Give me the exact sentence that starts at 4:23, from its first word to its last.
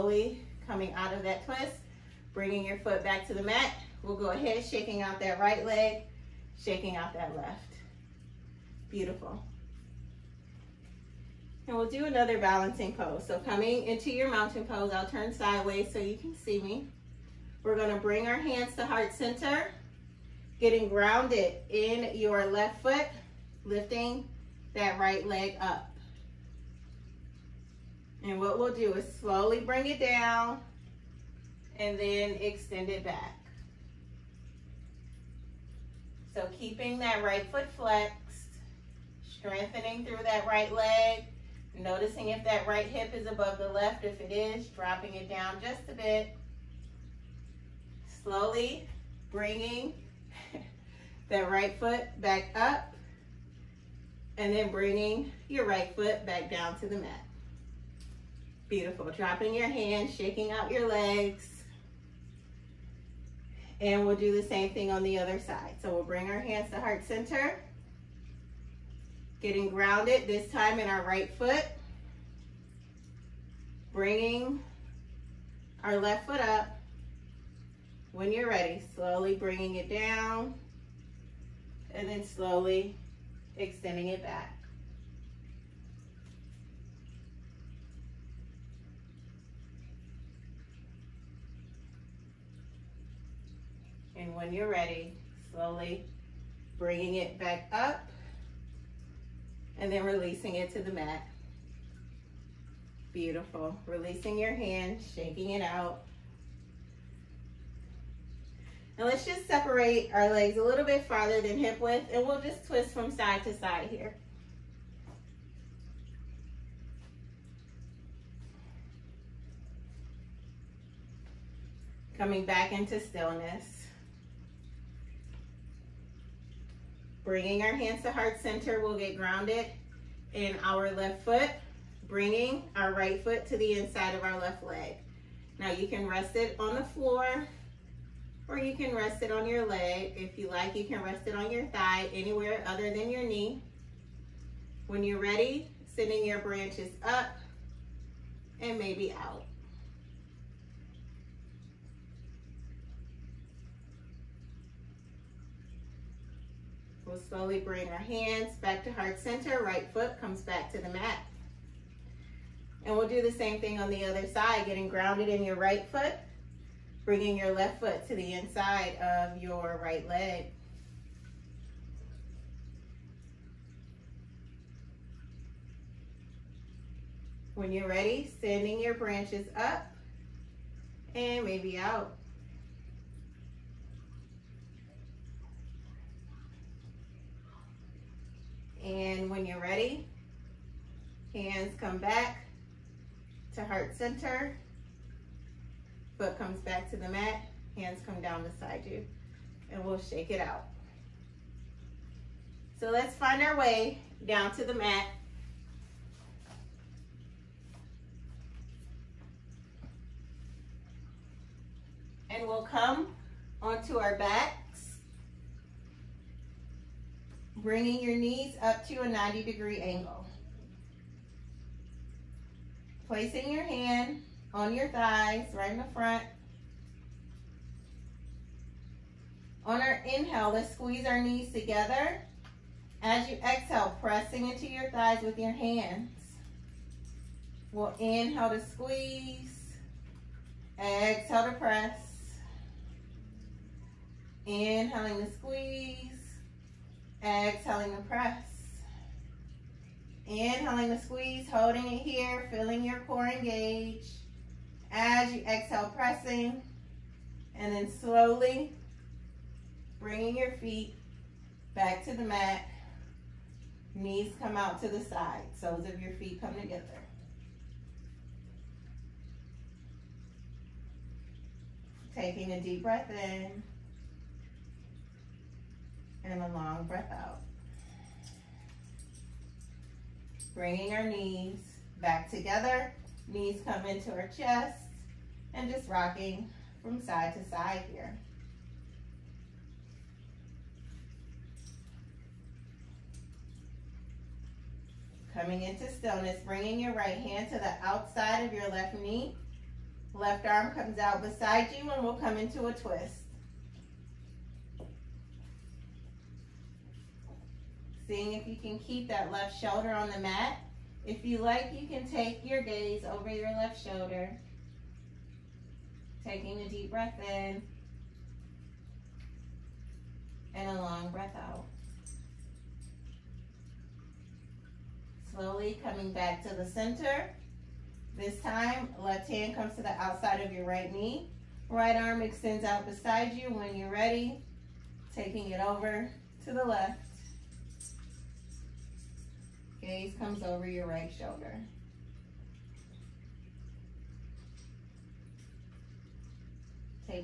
Knees come out to the side, soles of your feet come together.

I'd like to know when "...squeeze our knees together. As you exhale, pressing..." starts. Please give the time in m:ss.
3:50.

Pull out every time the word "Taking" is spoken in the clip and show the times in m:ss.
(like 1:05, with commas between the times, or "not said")
4:32, 5:16, 5:35.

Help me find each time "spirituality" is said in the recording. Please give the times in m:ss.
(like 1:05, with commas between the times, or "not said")
not said.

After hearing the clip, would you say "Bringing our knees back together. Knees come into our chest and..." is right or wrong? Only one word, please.
right.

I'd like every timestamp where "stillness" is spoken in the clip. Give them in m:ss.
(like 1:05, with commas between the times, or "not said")
2:02, 4:55.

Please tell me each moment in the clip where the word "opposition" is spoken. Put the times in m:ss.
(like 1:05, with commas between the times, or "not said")
not said.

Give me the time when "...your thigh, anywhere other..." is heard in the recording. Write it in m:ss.
2:21.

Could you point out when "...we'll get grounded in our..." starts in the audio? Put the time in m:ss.
2:08.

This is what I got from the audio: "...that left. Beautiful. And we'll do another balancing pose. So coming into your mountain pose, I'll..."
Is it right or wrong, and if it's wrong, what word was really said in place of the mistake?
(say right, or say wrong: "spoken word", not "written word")
right.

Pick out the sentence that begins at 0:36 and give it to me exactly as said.
So keeping that right foot flexed, strengthening through that right leg, noticing if that right hip is above the left.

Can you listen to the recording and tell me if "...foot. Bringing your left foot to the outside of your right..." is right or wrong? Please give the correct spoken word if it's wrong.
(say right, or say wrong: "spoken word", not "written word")
wrong: "inside", not "outside".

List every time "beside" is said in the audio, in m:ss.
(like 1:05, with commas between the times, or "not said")
3:18, 5:01, 5:32.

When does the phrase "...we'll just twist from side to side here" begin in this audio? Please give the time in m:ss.
1:52.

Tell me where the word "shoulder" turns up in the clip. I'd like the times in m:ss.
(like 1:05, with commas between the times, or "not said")
5:09, 5:13, 5:41.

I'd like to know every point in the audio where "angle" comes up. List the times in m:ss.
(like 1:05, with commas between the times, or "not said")
3:39.